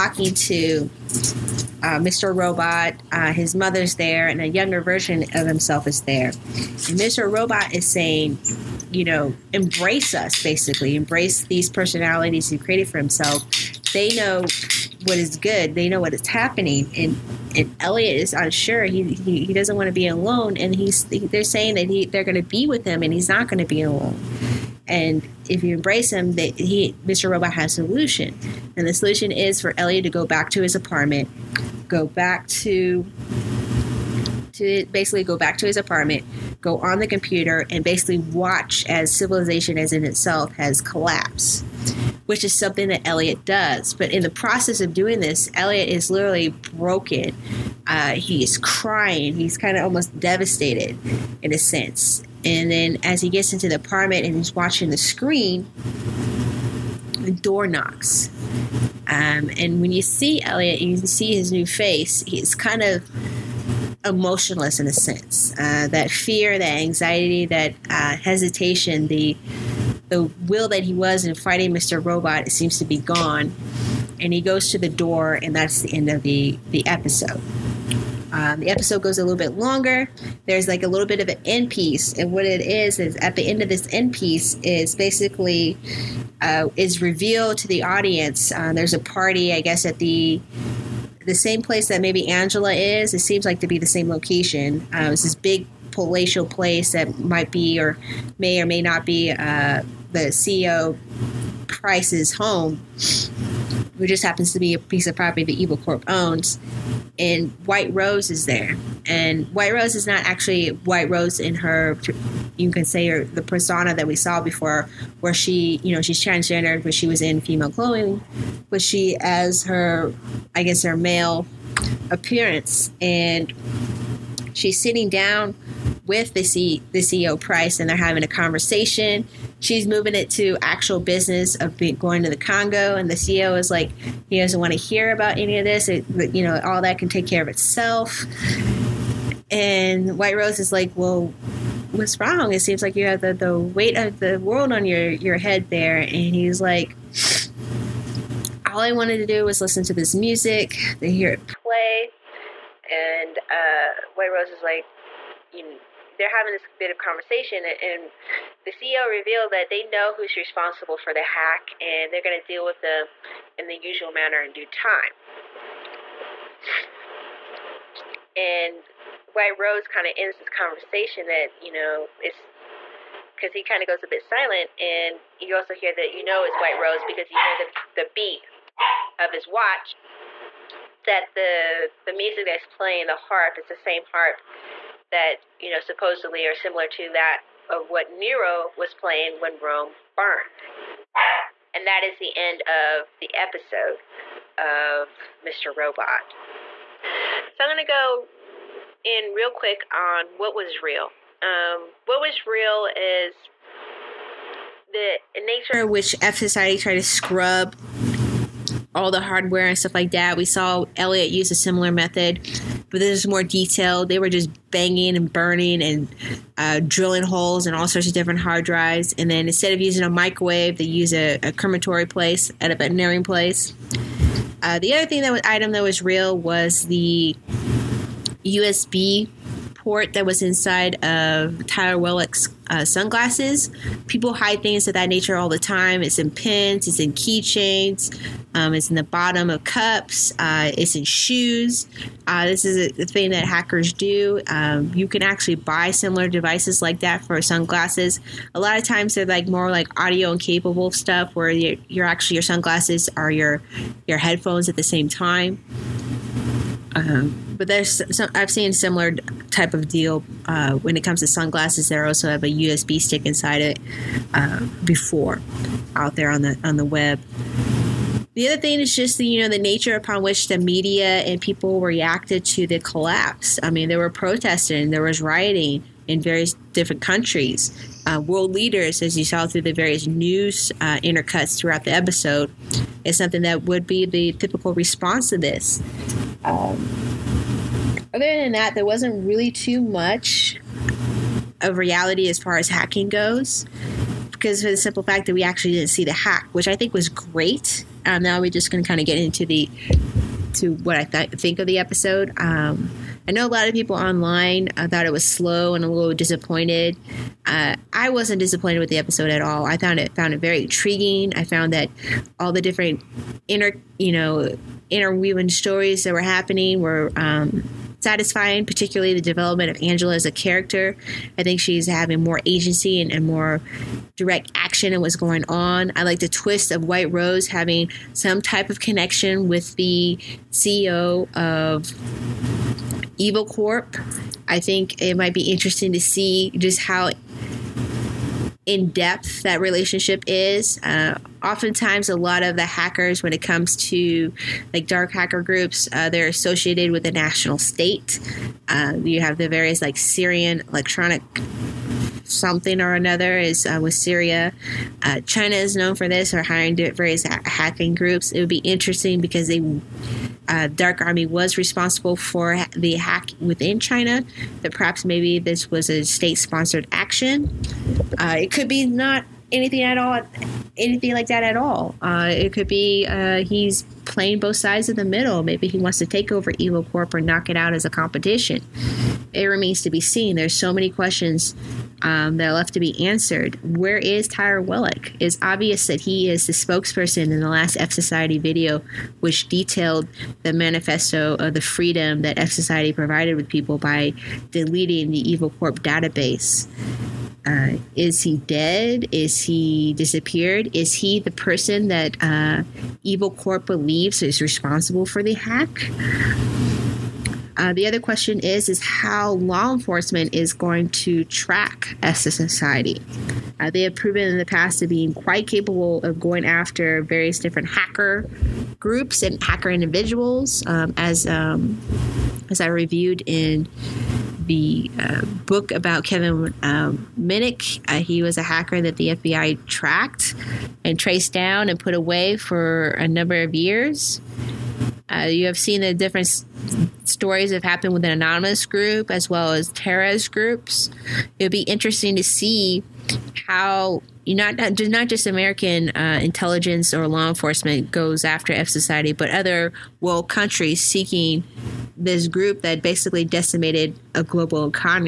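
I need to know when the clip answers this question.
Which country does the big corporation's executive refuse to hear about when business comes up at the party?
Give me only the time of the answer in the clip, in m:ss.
2:12.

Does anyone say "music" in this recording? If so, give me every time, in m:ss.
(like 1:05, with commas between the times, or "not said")
2:30, 3:02.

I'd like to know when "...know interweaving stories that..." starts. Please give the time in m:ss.
5:14.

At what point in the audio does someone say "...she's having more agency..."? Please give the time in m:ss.
5:21.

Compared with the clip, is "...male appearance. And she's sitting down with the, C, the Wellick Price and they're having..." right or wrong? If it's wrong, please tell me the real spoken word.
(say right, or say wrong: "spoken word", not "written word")
wrong: "CEO", not "Wellick".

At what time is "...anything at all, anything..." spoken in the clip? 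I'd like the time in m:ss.
6:09.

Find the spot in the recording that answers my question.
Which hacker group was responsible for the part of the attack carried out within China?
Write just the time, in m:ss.
6:00.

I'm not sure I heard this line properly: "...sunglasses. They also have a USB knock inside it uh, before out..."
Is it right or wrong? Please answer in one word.
wrong.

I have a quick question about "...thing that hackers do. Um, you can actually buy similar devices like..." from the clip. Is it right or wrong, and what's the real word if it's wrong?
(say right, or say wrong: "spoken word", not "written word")
right.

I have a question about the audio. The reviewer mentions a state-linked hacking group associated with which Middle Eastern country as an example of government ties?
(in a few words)
Syria.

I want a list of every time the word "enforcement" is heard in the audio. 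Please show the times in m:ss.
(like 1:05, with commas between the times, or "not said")
6:49, 7:27.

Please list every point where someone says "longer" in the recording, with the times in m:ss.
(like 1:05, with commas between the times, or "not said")
1:19.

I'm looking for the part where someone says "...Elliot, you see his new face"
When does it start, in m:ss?
1:00.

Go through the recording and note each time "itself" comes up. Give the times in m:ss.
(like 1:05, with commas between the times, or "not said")
0:40, 2:17.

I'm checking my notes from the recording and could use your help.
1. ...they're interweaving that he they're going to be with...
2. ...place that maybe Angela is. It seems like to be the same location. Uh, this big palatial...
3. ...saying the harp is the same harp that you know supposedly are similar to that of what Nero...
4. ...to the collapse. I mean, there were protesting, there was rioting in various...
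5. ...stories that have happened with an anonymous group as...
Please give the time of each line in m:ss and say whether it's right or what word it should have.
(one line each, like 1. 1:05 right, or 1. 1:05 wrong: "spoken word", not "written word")
1. 0:21 wrong: "saying", not "interweaving"
2. 1:31 right
3. 3:02 wrong: "playing", not "saying"
4. 4:32 right
5. 7:17 right.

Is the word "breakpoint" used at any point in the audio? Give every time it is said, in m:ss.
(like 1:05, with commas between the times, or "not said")
not said.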